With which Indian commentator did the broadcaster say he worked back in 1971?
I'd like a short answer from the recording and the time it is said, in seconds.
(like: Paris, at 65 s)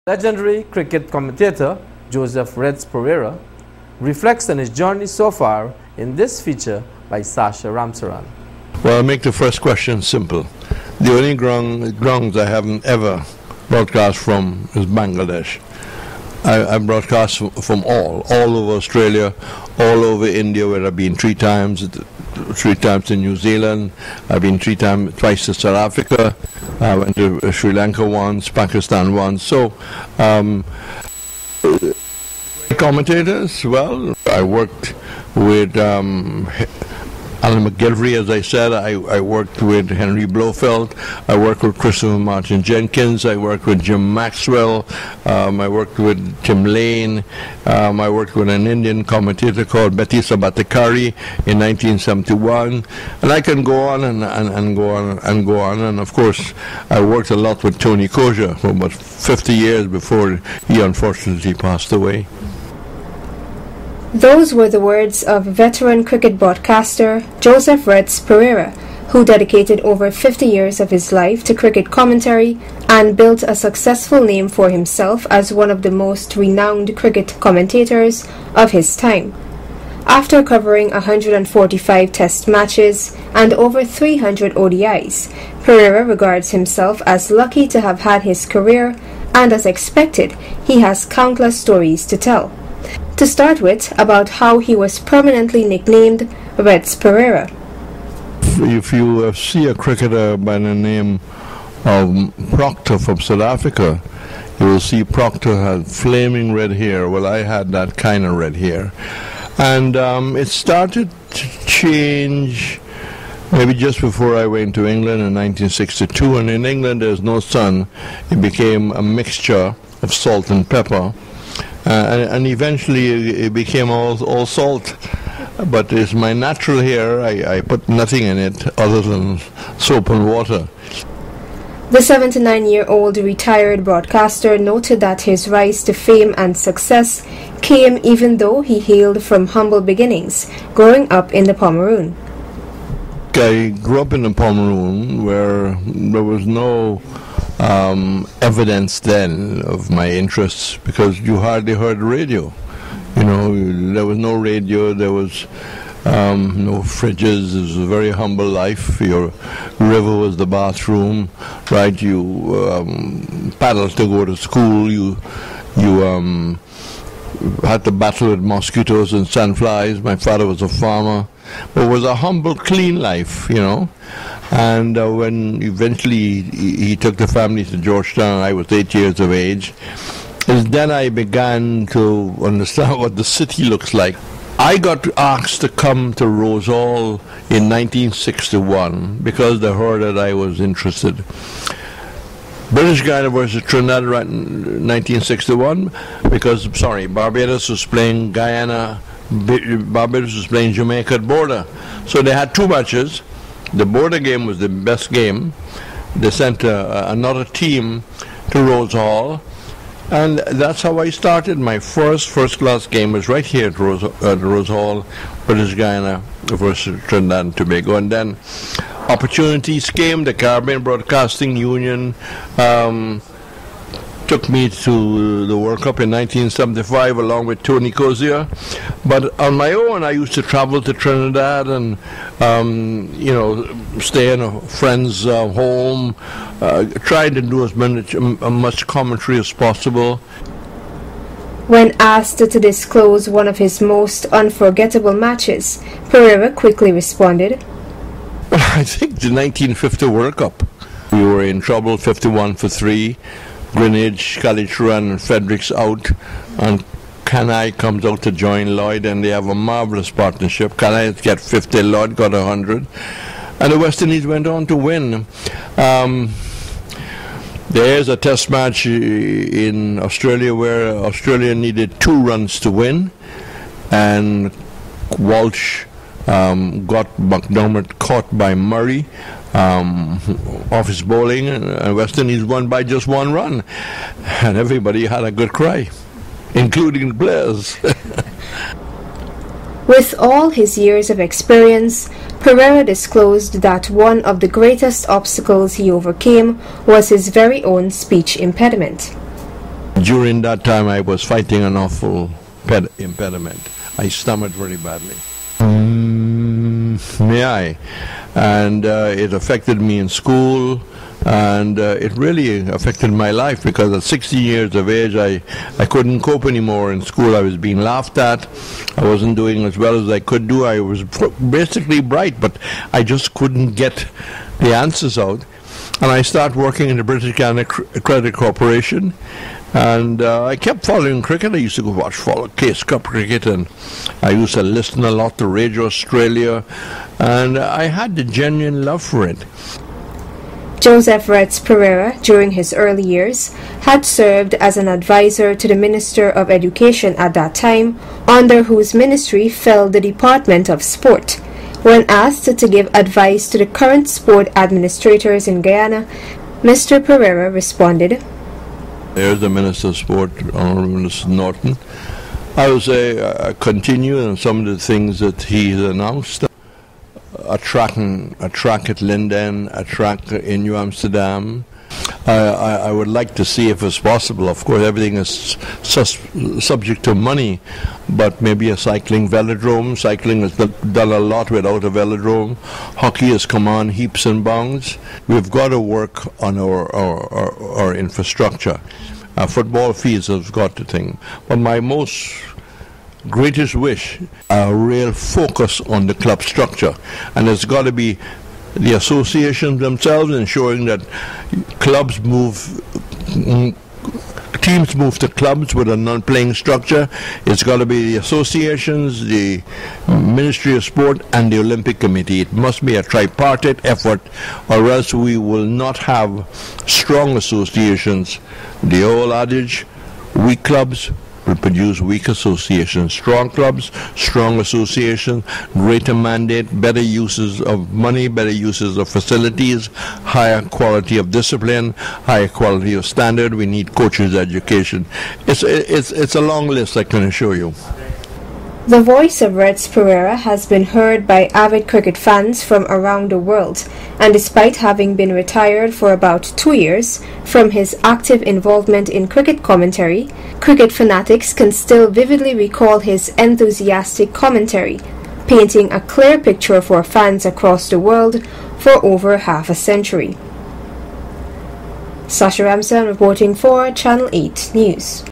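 Berry Sarbadhikary, at 49 s.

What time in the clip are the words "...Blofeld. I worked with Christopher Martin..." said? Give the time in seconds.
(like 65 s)
40 s.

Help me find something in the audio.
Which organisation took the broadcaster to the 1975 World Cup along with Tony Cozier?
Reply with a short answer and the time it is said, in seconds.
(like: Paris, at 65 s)
Caribbean Broadcasting Union, at 220 s.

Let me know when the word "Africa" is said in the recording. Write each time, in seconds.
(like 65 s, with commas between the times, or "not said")
25 s, 103 s.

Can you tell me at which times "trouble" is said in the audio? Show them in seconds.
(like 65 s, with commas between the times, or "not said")
251 s.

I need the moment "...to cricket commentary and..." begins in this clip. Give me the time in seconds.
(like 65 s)
71 s.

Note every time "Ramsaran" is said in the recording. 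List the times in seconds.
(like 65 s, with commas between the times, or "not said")
7 s, 462 s.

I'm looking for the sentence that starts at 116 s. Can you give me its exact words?
And in England, there's no sun.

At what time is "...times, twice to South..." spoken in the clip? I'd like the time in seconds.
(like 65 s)
24 s.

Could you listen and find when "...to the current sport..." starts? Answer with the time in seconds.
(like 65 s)
353 s.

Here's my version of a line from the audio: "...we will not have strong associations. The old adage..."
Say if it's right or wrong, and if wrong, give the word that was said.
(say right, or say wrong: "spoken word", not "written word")
right.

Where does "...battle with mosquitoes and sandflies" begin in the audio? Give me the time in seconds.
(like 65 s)
167 s.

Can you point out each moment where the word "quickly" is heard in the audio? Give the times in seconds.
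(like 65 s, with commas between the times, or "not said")
246 s.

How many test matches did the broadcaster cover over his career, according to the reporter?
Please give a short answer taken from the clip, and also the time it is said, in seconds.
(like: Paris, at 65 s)
145, at 80 s.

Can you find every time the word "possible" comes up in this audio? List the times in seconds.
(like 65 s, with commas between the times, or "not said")
239 s, 373 s.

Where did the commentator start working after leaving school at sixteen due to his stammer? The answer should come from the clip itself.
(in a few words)
British Guiana Credit Corporation.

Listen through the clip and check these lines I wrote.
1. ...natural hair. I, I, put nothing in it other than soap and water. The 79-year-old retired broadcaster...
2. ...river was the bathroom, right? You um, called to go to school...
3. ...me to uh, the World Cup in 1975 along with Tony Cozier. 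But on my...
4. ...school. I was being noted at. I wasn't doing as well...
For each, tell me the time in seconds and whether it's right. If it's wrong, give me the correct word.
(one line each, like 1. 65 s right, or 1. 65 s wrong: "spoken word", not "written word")
1. 126 s right
2. 159 s wrong: "paddled", not "called"
3. 224 s right
4. 317 s wrong: "laughed", not "noted".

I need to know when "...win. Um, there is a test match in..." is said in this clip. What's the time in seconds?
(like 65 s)
264 s.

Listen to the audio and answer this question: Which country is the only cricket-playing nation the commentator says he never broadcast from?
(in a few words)
Bangladesh.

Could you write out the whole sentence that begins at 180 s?
Is then I began to understand what the city looks like.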